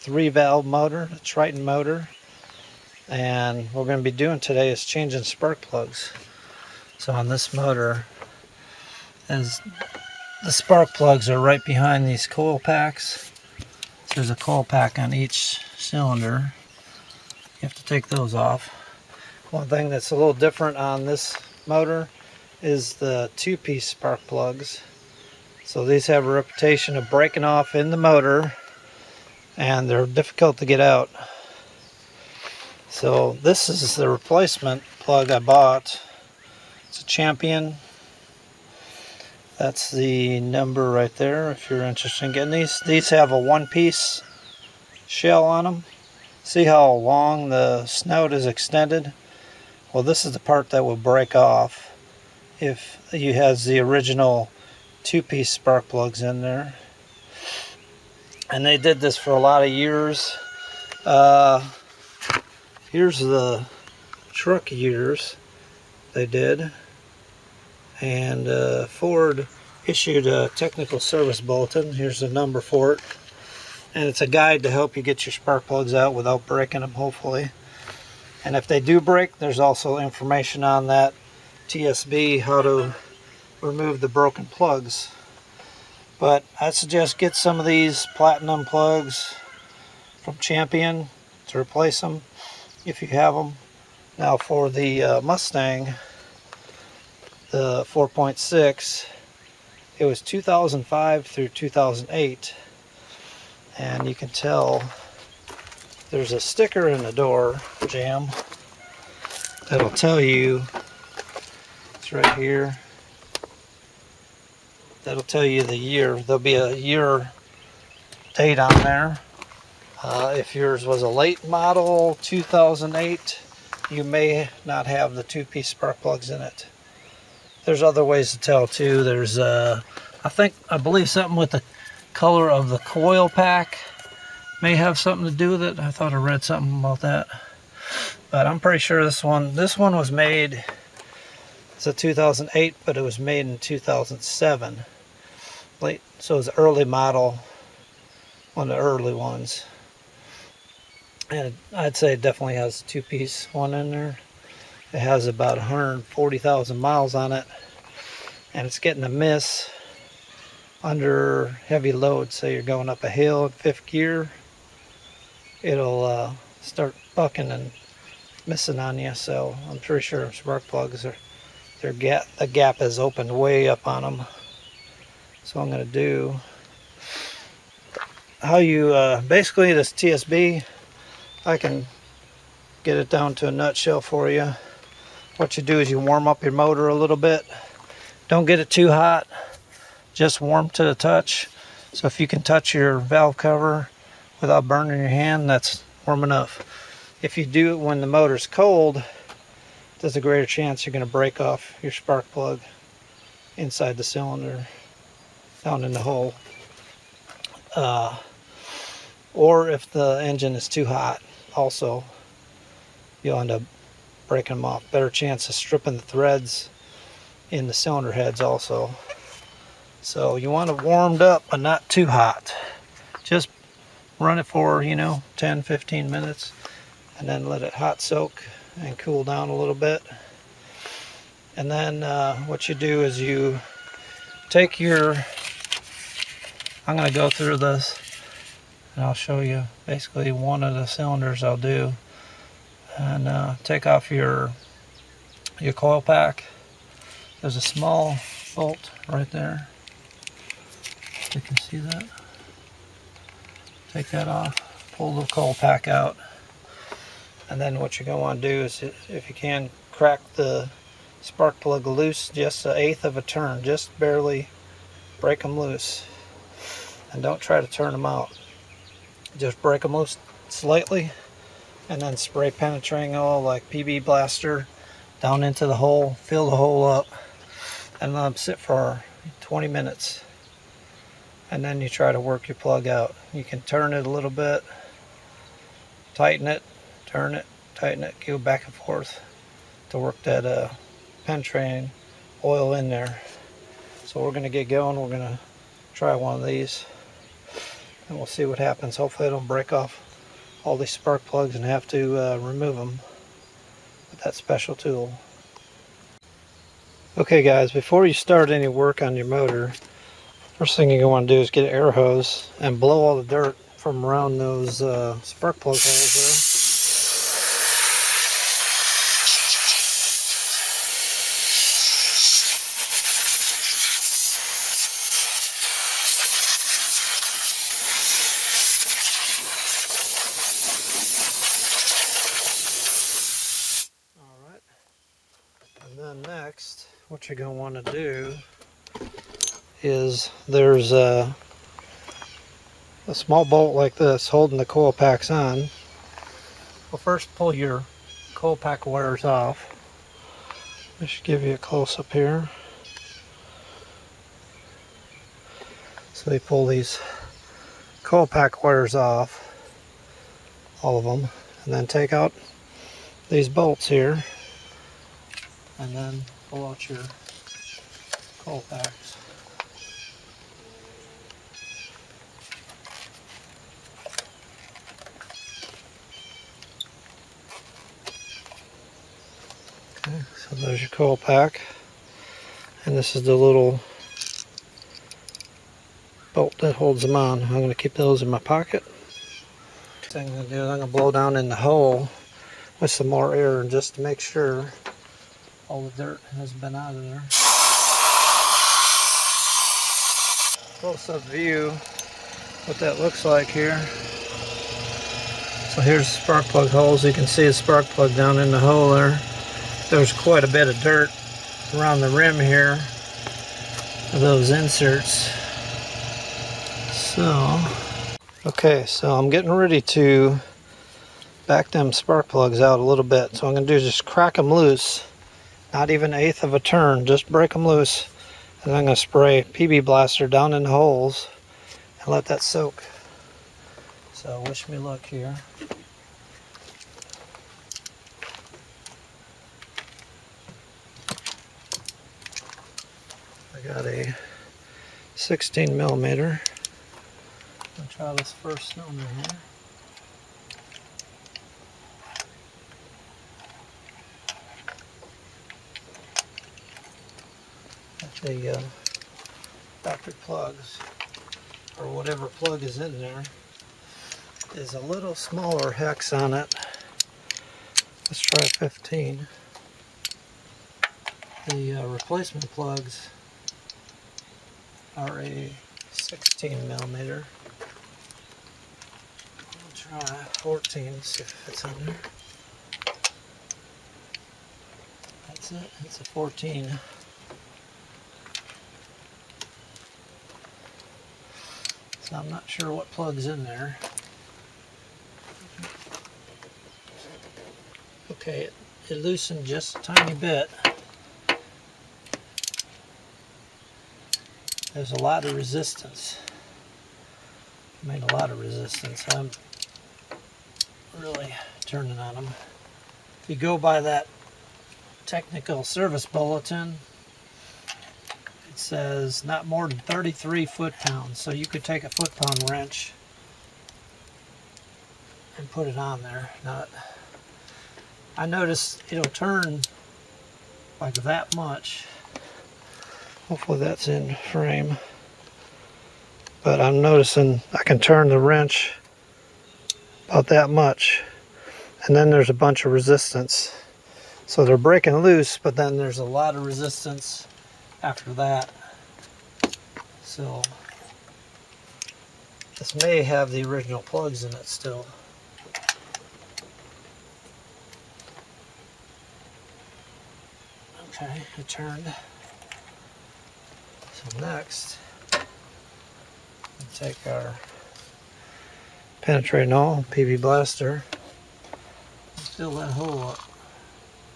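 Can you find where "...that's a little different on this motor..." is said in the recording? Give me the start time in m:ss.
0:19.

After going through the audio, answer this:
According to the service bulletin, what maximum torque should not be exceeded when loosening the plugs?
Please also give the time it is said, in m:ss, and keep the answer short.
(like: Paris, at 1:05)
33 foot-pounds, at 8:39.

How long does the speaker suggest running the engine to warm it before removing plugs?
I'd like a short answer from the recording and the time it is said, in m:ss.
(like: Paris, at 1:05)
10 to 15 minutes, at 3:45.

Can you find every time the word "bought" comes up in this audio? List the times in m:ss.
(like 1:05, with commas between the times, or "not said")
0:35.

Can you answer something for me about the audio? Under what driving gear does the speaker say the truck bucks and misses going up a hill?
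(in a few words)
fifth gear.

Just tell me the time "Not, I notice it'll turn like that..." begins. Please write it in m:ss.
8:46.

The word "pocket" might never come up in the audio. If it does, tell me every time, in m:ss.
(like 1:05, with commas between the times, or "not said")
6:28.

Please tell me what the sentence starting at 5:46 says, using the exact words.
Well, first pull your coil pack wires off.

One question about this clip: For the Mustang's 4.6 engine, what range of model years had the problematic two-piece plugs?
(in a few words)
2005 through 2008.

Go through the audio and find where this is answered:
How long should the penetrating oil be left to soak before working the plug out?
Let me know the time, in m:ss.
4:39.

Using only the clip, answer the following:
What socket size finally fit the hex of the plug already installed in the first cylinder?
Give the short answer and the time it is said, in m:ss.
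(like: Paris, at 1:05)
14 mm, at 8:05.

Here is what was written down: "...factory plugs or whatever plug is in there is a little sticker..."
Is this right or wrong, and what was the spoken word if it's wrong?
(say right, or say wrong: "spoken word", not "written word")
wrong: "smaller", not "sticker".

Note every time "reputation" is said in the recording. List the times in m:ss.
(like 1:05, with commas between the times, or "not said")
0:26.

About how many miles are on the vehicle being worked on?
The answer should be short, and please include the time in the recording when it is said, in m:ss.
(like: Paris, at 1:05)
140,000, at 2:35.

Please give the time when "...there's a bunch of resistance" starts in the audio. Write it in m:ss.
9:02.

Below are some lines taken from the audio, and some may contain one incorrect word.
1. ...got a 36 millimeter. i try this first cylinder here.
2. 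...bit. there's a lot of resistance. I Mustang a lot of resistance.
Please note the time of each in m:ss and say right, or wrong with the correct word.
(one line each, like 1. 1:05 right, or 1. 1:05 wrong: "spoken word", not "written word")
1. 7:23 wrong: "16", not "36"
2. 8:20 wrong: "Made", not "Mustang".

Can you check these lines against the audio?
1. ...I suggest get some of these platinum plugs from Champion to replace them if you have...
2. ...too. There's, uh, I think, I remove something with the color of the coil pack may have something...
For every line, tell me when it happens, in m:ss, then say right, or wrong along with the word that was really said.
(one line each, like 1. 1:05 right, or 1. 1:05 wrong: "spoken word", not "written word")
1. 1:26 right
2. 2:08 wrong: "believe", not "remove".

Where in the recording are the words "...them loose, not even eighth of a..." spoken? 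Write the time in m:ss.
7:04.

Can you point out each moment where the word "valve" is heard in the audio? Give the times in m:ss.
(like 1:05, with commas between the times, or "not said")
0:00, 3:12.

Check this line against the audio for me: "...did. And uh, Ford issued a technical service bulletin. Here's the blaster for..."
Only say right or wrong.
wrong.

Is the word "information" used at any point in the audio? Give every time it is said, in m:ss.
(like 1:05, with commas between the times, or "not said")
1:19.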